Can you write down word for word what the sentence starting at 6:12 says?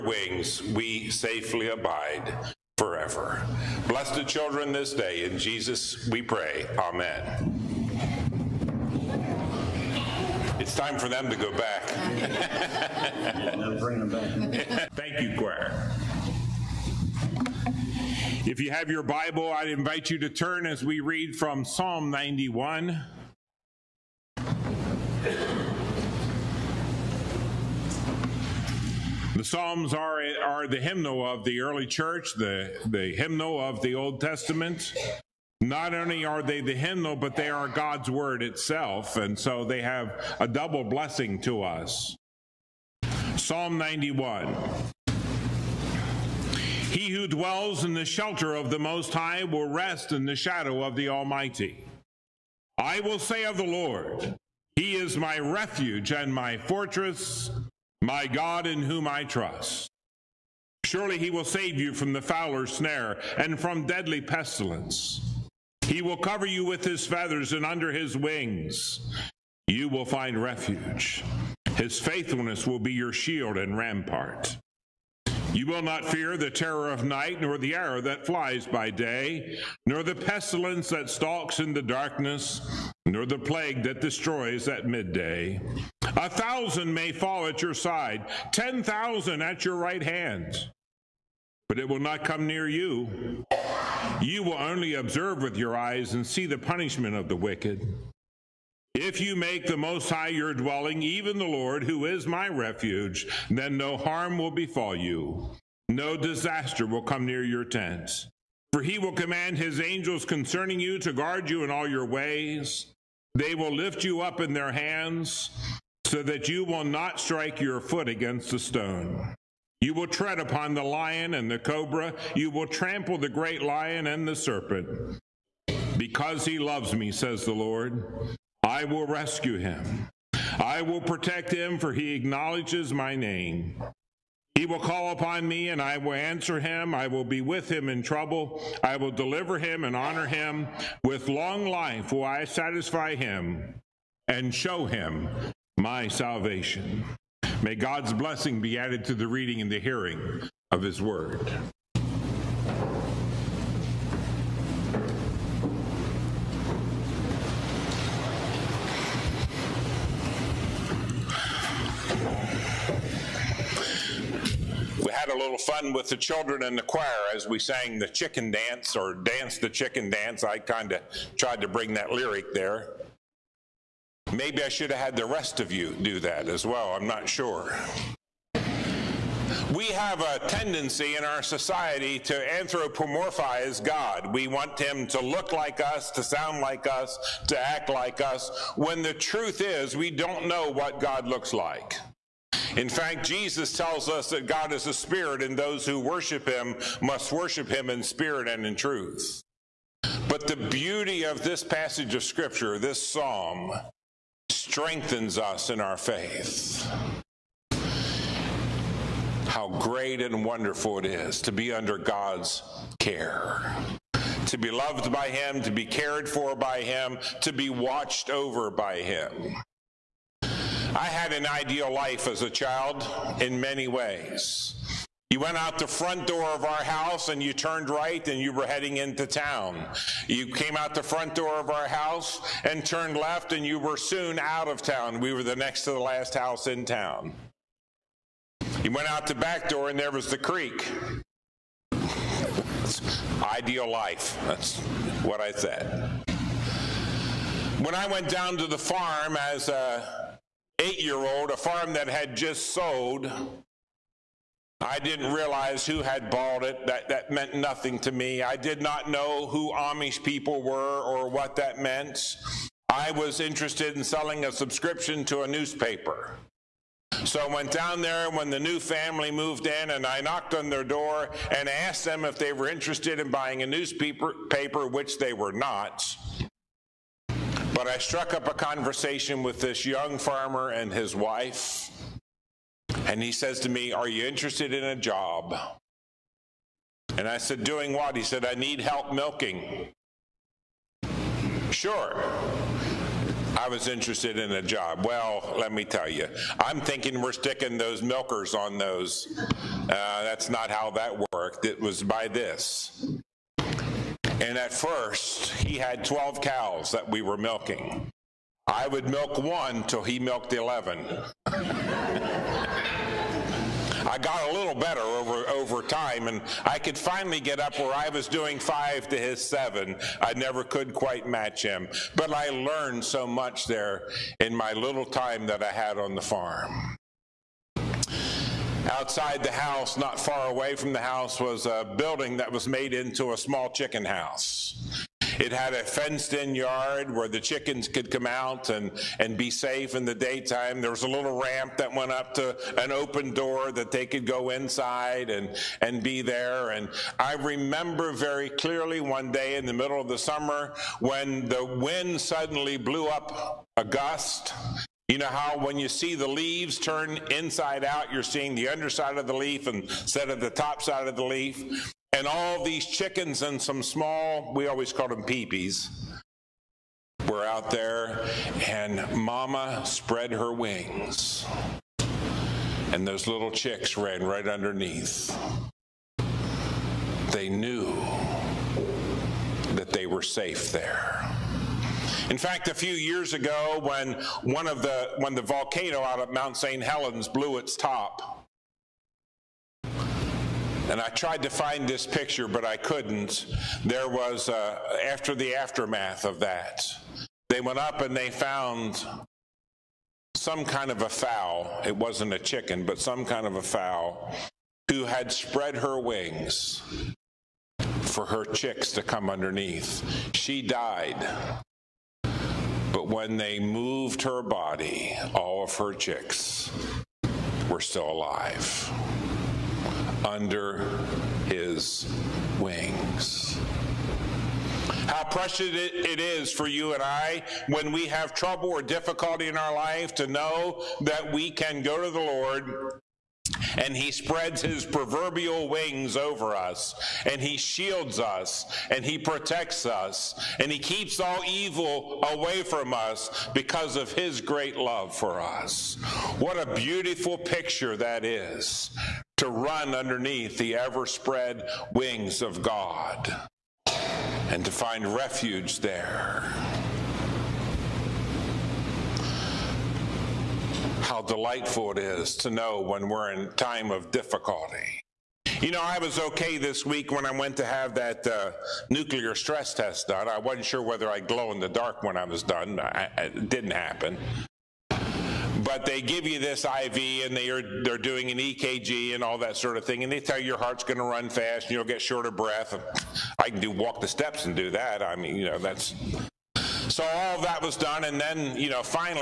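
And those little chicks ran right underneath.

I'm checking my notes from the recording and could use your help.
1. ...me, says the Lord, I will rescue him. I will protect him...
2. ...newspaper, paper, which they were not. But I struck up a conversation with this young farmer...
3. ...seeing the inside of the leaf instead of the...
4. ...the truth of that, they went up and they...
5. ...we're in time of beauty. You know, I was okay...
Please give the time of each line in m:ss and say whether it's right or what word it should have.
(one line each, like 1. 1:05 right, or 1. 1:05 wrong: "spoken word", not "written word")
1. 2:06 right
2. 4:33 right
3. 5:58 wrong: "underside", not "inside"
4. 6:35 wrong: "aftermath", not "truth"
5. 7:43 wrong: "difficulty", not "beauty".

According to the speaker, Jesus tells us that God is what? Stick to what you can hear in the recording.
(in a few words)
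a spirit.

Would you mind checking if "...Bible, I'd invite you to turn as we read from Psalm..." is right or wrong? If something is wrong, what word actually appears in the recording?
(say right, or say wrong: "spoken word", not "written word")
right.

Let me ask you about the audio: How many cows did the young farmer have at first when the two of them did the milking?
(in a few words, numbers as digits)
12.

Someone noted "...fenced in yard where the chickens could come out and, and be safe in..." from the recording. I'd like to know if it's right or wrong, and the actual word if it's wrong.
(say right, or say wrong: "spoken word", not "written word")
right.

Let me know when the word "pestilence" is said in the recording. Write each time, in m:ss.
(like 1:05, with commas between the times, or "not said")
1:04, 1:20.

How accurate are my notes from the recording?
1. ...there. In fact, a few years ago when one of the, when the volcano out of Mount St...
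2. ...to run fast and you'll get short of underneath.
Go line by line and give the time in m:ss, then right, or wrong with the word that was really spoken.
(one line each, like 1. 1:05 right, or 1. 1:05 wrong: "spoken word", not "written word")
1. 6:20 right
2. 8:00 wrong: "breath", not "underneath".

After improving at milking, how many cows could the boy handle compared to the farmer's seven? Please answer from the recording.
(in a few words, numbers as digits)
5.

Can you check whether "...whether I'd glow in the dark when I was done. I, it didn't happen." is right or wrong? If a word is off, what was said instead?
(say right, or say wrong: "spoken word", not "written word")
right.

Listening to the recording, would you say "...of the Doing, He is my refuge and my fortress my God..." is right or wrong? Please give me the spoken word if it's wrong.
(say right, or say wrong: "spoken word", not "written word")
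wrong: "Lord", not "Doing".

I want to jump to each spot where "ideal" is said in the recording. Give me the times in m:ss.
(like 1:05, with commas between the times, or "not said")
3:41, 4:03.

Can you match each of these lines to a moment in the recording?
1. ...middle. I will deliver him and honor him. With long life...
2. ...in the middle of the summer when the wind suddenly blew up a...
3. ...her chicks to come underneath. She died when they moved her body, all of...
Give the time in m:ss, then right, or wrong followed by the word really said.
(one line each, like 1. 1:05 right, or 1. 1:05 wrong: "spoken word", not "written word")
1. 2:18 wrong: "trouble", not "middle"
2. 5:49 right
3. 6:48 right.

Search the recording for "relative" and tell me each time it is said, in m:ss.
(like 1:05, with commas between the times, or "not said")
not said.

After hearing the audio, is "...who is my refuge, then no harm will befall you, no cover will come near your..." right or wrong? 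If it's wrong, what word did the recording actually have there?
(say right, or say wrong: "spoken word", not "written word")
wrong: "disaster", not "cover".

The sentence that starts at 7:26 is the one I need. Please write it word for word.
What a beautiful picture that is to run underneath the ever spread wings of God and to find refuge there.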